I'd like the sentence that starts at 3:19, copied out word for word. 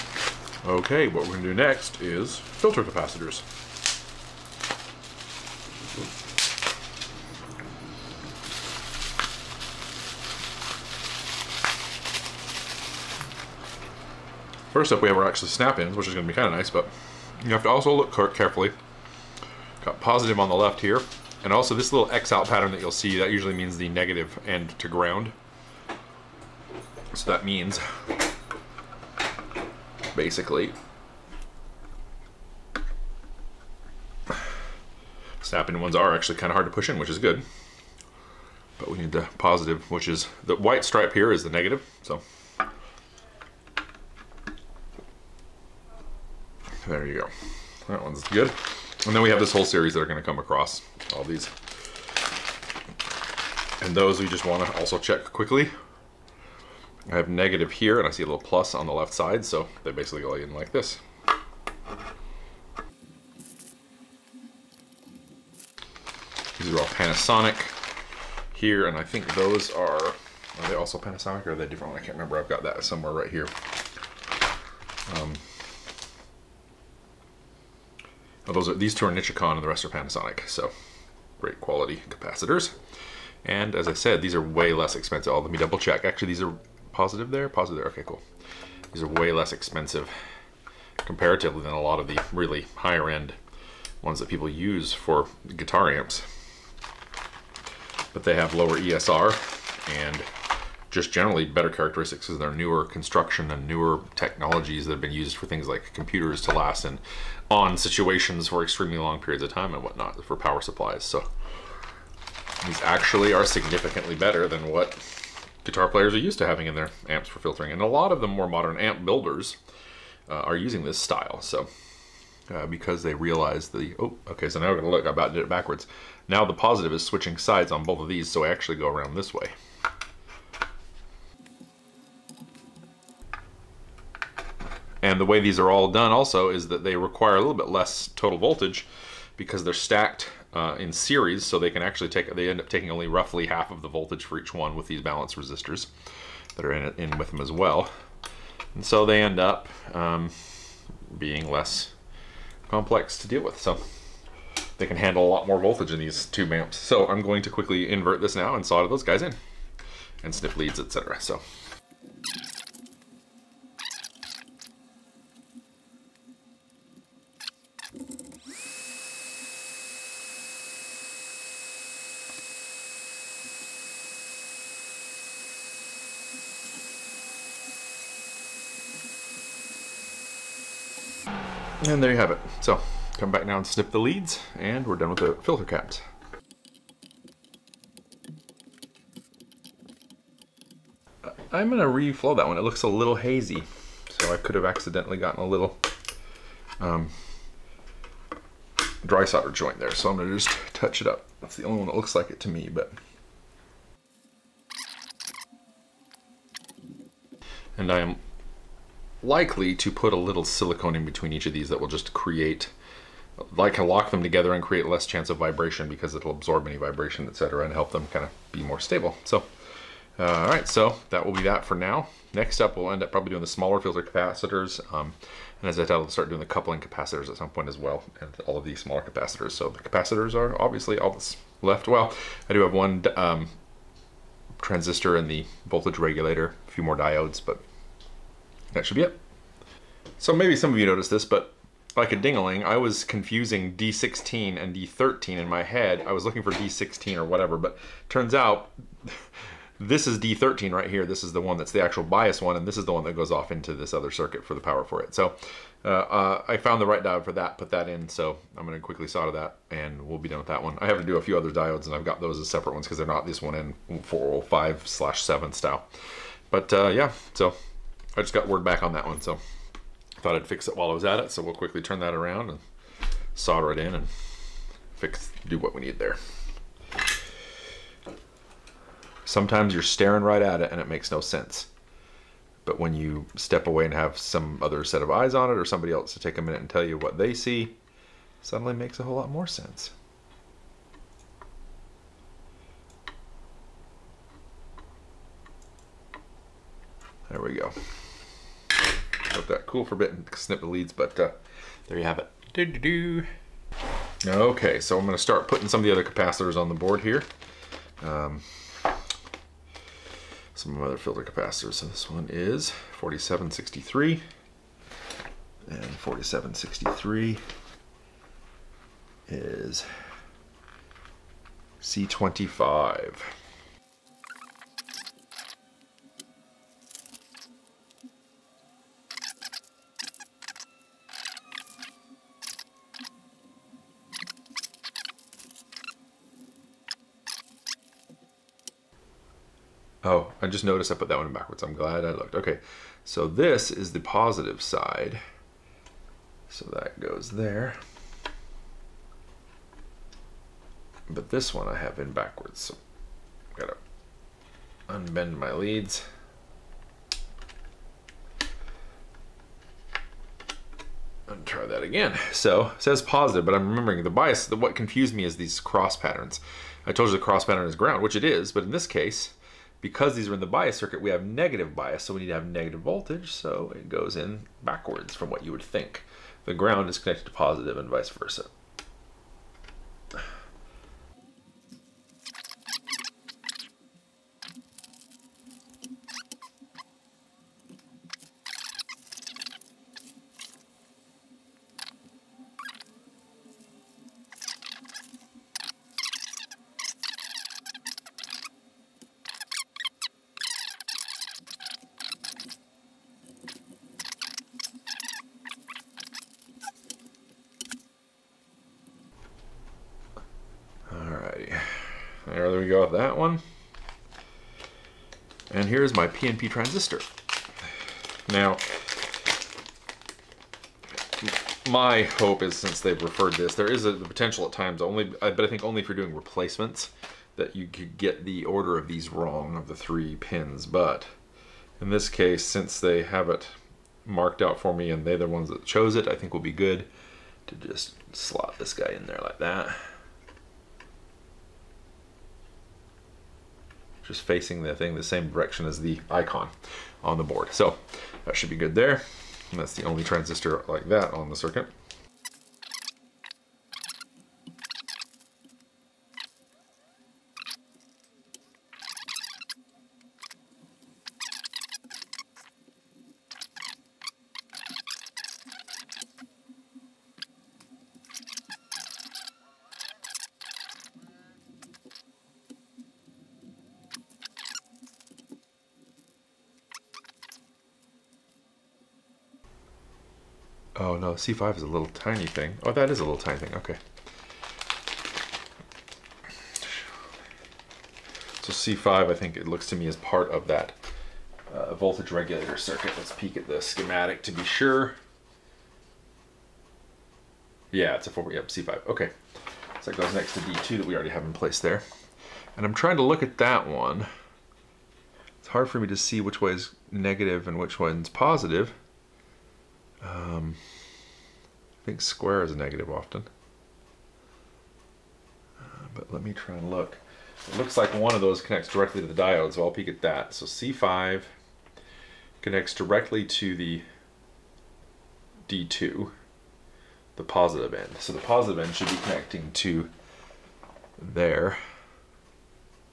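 So I'm gonna just touch it up.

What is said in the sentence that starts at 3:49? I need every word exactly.
So the capacitors are obviously all that's left.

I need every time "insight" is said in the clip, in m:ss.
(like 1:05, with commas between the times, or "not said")
not said.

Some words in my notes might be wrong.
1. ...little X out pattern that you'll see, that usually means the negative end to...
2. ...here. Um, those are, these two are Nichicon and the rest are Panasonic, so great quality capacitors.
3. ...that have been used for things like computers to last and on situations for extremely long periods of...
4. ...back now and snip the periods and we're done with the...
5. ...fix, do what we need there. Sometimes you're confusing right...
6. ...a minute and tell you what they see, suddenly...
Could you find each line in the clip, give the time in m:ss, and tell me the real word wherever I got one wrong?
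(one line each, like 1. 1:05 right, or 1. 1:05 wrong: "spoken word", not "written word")
1. 0:21 right
2. 1:13 right
3. 1:44 right
4. 3:03 wrong: "leads", not "periods"
5. 4:34 wrong: "staring", not "confusing"
6. 4:46 right.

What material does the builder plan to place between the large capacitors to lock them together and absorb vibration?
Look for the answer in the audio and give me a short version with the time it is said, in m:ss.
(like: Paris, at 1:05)
Silicone, at 3:30.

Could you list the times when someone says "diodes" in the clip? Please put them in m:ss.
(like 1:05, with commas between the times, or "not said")
3:56, 4:17, 4:21, 8:39.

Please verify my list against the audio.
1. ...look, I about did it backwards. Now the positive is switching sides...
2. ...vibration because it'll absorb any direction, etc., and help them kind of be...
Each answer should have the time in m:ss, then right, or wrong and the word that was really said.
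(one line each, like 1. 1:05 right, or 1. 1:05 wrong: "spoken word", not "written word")
1. 2:04 right
2. 3:35 wrong: "vibration", not "direction".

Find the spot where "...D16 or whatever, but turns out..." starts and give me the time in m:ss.
4:06.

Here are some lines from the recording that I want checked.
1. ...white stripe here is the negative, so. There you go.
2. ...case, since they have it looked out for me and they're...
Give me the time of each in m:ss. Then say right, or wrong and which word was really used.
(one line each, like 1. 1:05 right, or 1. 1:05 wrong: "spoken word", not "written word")
1. 0:40 right
2. 7:12 wrong: "marked", not "looked".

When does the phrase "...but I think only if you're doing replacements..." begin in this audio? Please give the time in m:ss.
7:05.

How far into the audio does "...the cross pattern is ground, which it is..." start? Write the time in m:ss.
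6:07.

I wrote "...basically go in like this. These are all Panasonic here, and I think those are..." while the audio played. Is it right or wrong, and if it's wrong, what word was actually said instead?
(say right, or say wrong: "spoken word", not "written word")
right.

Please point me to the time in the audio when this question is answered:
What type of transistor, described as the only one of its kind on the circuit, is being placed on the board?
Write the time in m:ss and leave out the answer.
6:56.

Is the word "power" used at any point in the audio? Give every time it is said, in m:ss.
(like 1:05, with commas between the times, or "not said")
1:50, 4:14.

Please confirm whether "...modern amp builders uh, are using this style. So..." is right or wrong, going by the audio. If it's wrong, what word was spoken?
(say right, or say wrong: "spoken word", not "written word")
right.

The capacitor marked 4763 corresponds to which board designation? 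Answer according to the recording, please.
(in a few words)
C25.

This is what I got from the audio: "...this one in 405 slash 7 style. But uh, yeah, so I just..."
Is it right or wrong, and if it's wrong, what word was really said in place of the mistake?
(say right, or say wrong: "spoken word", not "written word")
right.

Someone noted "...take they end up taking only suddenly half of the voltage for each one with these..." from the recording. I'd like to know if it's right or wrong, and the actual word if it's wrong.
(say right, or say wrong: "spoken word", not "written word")
wrong: "roughly", not "suddenly".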